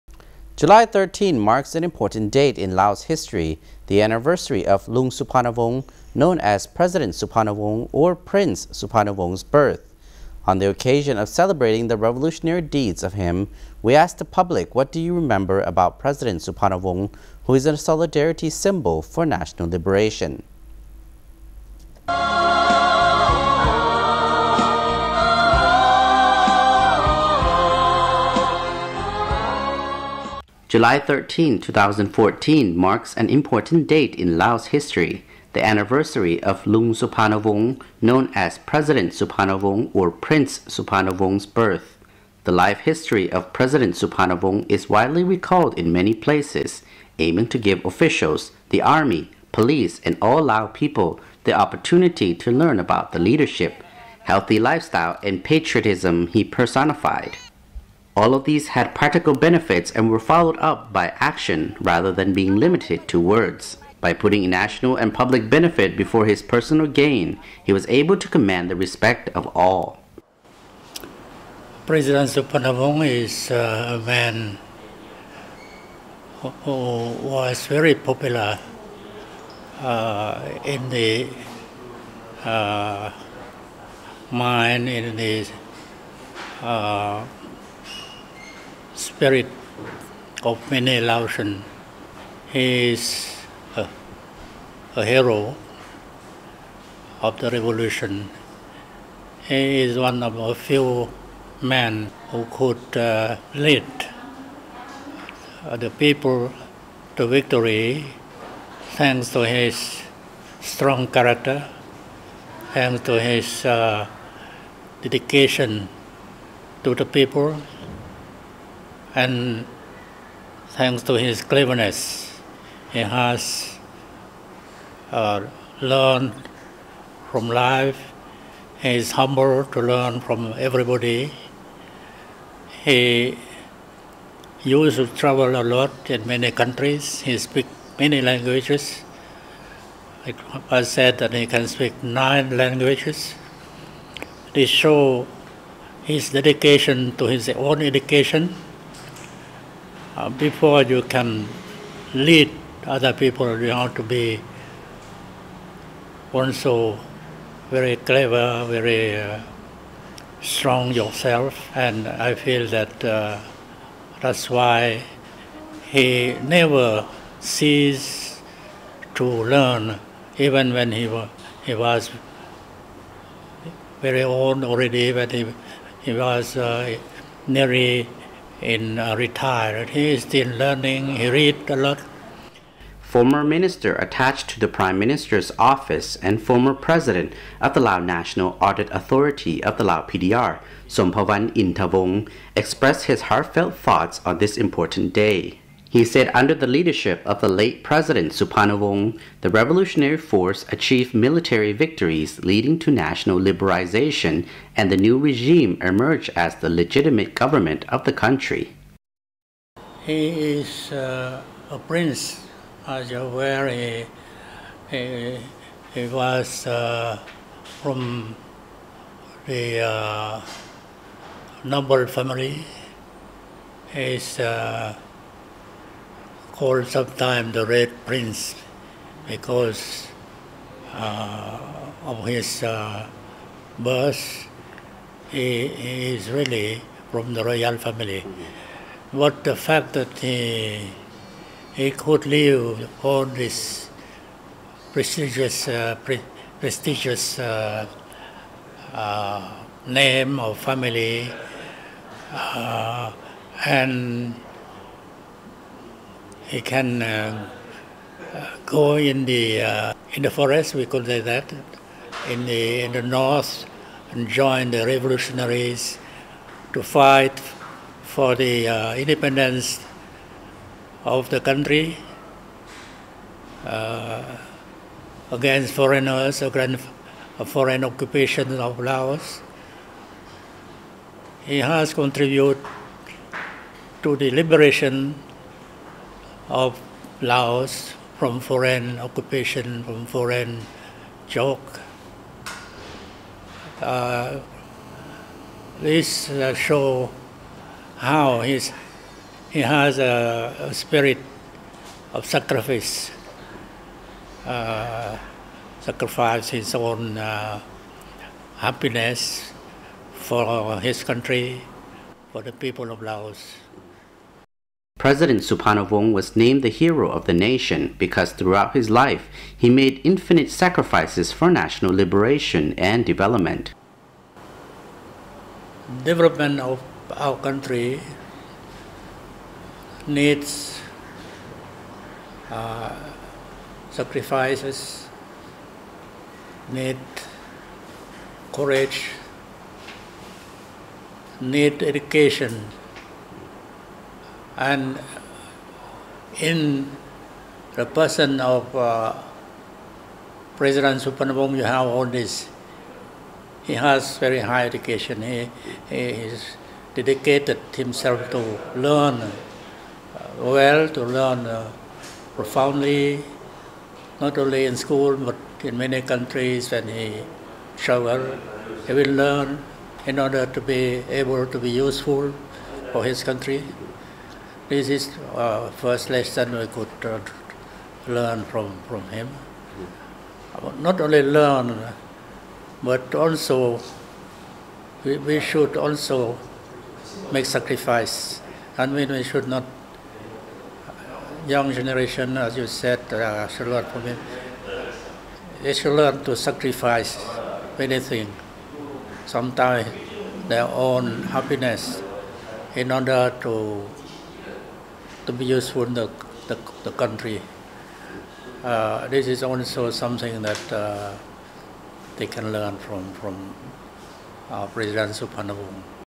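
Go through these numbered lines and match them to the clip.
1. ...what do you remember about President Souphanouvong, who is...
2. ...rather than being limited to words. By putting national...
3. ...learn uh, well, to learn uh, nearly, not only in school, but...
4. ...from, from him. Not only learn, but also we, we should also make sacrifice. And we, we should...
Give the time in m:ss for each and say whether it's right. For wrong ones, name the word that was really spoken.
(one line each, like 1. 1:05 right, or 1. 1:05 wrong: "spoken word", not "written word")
1. 0:14 right
2. 1:01 right
3. 5:58 wrong: "profoundly", not "nearly"
4. 6:18 right.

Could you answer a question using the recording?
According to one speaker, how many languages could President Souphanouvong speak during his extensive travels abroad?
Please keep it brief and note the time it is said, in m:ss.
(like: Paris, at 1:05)
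9, at 2:22.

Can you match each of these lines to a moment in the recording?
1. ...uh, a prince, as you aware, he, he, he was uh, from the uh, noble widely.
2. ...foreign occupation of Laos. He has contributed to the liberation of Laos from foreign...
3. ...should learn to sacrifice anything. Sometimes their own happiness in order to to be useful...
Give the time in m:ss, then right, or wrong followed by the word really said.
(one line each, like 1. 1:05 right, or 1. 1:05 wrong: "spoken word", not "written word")
1. 3:30 wrong: "family", not "widely"
2. 4:37 right
3. 6:35 right.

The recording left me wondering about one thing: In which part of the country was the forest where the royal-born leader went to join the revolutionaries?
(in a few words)
the north.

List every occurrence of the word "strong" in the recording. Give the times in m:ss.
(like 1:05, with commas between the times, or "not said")
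1:50, 2:40.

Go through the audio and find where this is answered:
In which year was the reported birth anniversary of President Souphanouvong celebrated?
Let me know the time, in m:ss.
0:31.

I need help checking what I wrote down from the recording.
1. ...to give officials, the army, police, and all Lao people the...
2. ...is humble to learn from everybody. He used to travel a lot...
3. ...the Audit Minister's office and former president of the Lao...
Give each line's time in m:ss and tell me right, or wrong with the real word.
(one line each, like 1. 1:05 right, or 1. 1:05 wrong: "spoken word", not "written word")
1. 0:47 right
2. 2:08 right
3. 3:04 wrong: "Prime", not "Audit".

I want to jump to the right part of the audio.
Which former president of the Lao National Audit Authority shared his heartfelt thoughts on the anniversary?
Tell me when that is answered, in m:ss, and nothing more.
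3:10.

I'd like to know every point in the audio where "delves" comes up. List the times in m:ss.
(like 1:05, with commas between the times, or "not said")
not said.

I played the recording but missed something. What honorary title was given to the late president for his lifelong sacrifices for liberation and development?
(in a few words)
hero of the nation.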